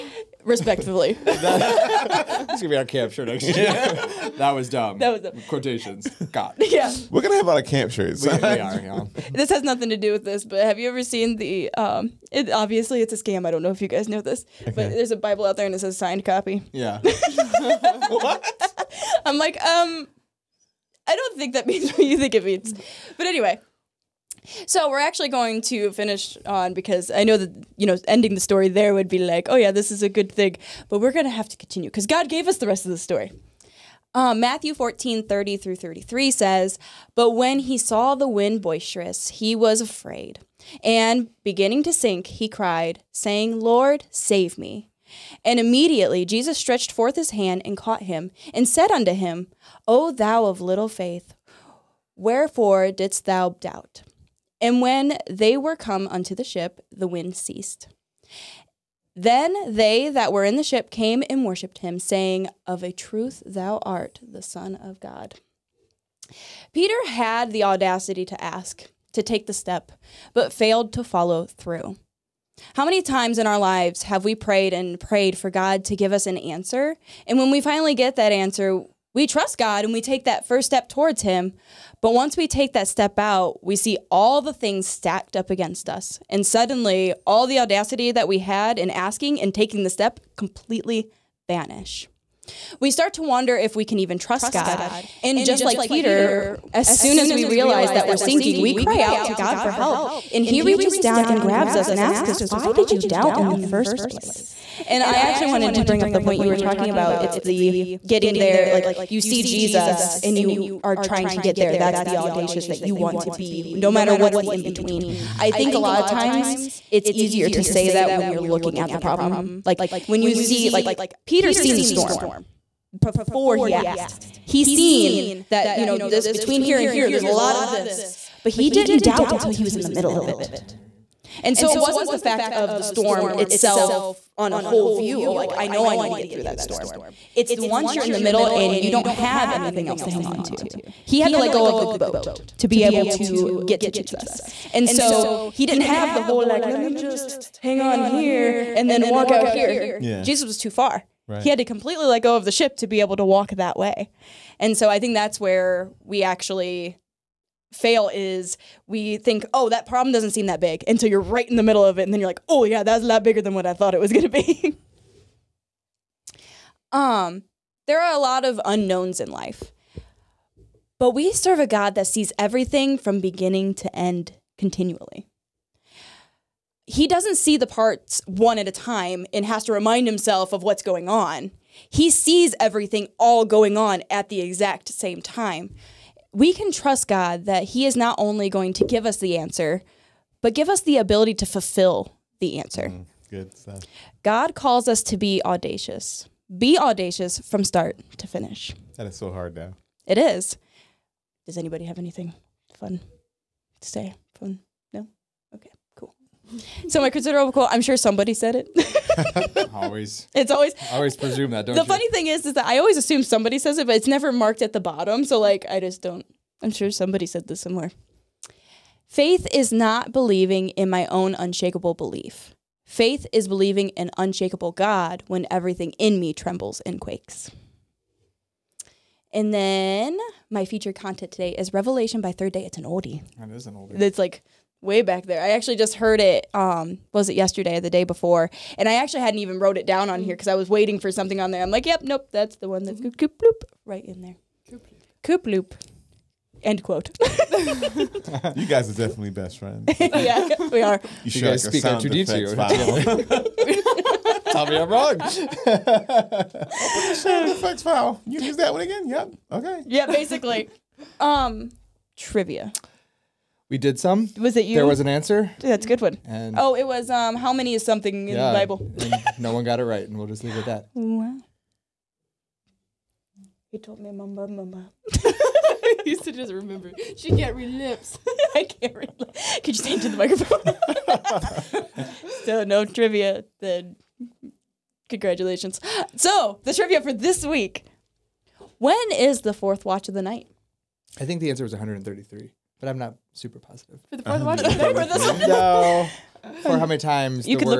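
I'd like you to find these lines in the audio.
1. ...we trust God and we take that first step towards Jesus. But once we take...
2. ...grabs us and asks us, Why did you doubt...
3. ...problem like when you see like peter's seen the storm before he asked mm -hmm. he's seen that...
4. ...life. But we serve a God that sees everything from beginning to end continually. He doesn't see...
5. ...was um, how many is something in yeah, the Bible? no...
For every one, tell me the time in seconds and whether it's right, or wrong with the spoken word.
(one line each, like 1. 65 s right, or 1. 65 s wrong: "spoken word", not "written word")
1. 79 s wrong: "Him", not "Jesus"
2. 101 s right
3. 118 s right
4. 169 s right
5. 266 s right.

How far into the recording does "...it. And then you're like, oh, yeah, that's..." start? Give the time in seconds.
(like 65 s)
161 s.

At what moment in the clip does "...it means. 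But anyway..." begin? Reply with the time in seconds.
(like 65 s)
22 s.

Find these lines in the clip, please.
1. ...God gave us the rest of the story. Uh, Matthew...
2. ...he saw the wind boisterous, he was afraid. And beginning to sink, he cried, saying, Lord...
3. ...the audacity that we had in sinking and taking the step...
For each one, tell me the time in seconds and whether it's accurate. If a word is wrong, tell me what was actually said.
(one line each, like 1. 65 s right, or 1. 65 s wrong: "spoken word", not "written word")
1. 32 s right
2. 37 s right
3. 87 s wrong: "asking", not "sinking".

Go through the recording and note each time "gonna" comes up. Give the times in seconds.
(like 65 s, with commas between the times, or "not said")
2 s, 7 s.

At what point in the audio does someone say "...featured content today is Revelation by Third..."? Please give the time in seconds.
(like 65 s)
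230 s.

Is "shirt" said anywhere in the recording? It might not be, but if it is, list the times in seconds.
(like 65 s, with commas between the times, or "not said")
3 s, 7 s.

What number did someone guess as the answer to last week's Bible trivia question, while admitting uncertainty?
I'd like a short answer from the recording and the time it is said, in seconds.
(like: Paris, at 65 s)
133, at 291 s.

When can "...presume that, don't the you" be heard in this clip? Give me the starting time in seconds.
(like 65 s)
211 s.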